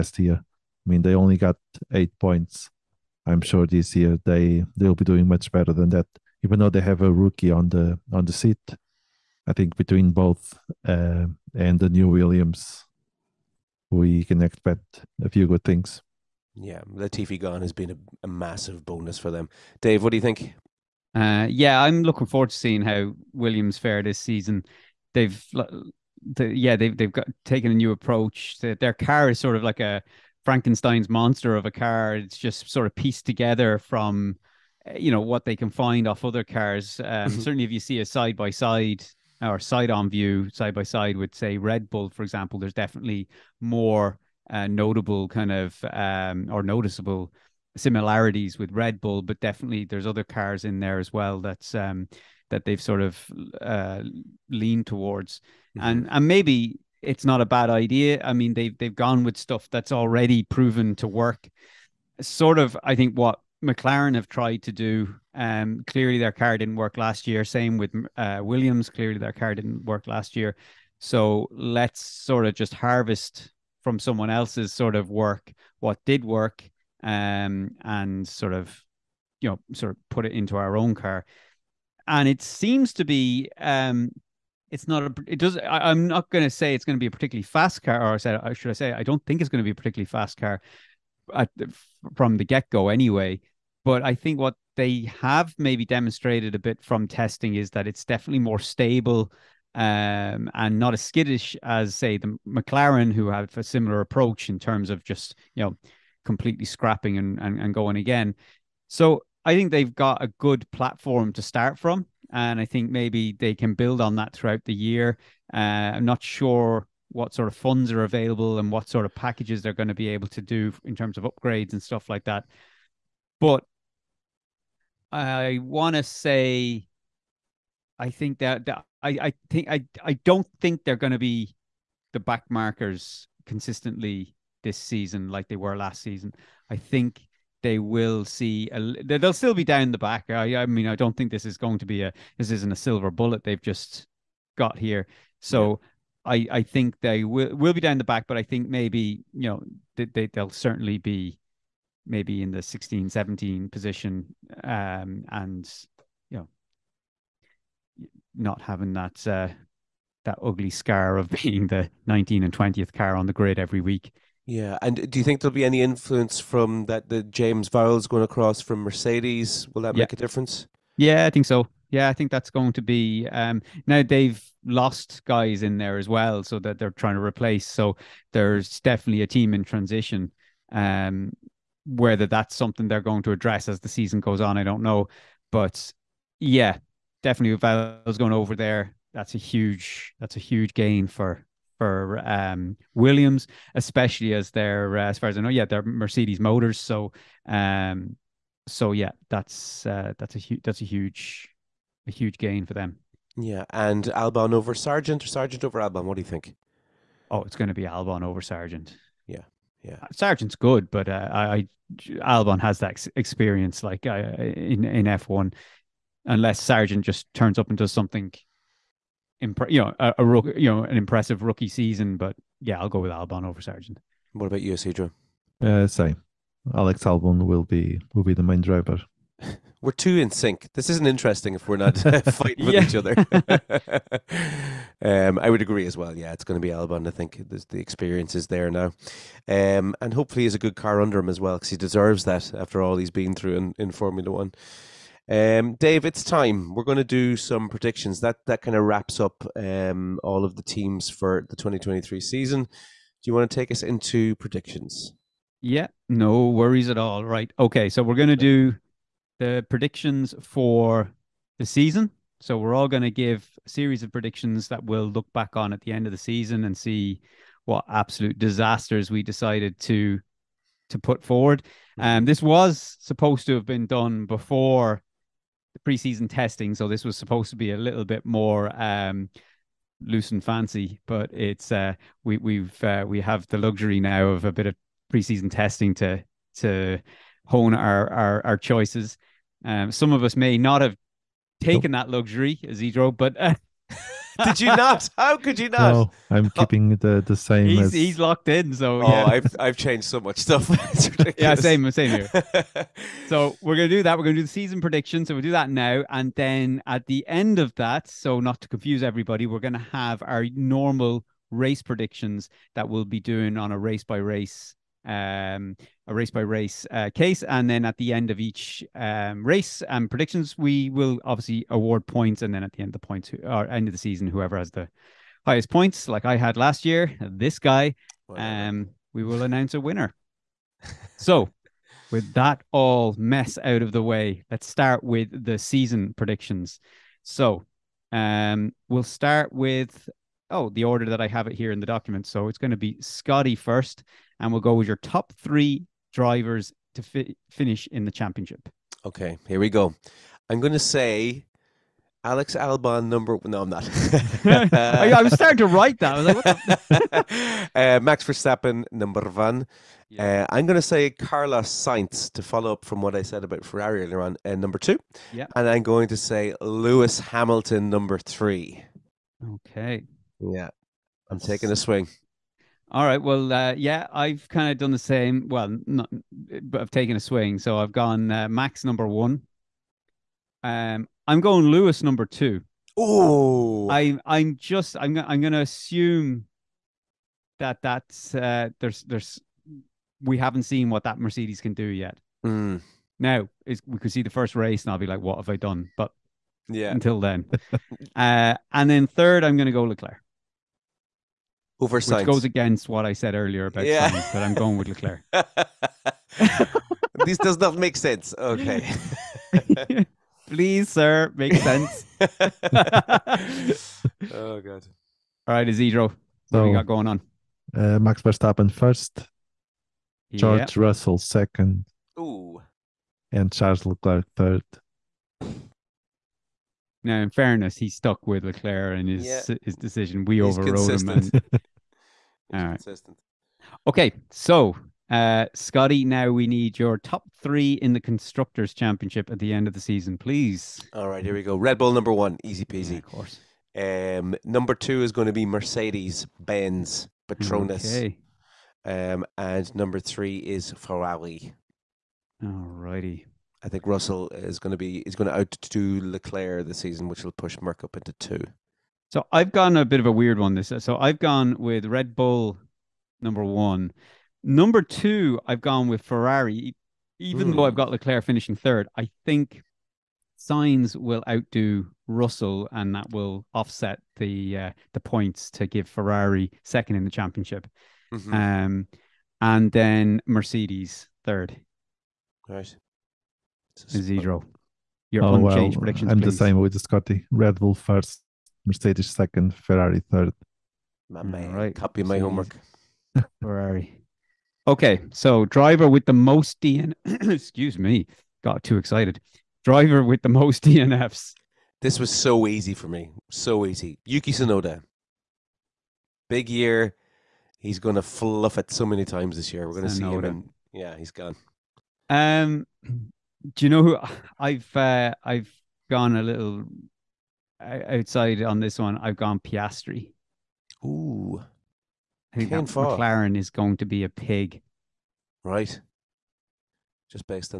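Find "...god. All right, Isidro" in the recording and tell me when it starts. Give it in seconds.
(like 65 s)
414 s.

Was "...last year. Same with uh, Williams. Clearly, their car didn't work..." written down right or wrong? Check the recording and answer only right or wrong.
right.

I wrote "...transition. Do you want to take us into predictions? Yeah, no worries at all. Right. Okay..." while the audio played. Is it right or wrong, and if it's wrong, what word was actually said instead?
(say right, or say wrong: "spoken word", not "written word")
wrong: "season", not "transition".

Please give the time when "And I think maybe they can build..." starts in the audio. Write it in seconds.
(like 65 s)
112 s.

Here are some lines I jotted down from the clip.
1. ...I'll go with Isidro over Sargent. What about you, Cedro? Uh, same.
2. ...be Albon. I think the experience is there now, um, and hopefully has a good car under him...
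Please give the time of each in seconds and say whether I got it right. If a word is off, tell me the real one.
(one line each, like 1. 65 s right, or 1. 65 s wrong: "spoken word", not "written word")
1. 222 s wrong: "Albon", not "Isidro"
2. 236 s right.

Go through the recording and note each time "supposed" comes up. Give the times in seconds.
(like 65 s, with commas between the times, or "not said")
273 s, 277 s.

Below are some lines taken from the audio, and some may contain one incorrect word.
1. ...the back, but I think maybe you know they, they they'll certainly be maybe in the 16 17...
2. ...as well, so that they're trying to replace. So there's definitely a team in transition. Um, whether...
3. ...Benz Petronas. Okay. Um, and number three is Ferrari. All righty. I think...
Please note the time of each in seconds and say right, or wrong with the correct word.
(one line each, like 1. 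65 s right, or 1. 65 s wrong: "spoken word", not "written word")
1. 147 s right
2. 175 s right
3. 446 s right.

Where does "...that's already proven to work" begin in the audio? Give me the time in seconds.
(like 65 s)
59 s.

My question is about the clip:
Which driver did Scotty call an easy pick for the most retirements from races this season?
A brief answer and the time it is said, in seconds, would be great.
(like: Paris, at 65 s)
Yuki Tsunoda, at 504 s.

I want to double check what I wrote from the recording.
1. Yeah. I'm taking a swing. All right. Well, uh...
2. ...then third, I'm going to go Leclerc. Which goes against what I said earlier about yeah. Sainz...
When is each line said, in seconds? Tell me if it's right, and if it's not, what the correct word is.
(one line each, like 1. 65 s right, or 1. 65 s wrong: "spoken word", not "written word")
1. 370 s right
2. 398 s right.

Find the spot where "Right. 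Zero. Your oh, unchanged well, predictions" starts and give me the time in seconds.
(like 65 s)
482 s.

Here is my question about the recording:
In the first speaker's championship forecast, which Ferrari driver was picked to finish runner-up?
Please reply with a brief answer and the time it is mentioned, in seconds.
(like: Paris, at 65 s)
Carlos Sainz, at 361 s.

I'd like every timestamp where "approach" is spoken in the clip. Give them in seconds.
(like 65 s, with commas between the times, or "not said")
27 s, 104 s.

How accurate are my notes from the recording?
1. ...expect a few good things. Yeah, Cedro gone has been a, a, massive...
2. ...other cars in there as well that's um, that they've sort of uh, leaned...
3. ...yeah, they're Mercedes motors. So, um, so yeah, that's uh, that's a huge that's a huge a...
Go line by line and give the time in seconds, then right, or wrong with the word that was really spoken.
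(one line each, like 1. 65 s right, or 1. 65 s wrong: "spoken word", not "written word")
1. 14 s wrong: "Latifi", not "Cedro"
2. 50 s right
3. 195 s right.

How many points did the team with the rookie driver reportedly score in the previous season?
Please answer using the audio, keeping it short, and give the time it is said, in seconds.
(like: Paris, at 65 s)
8, at 1 s.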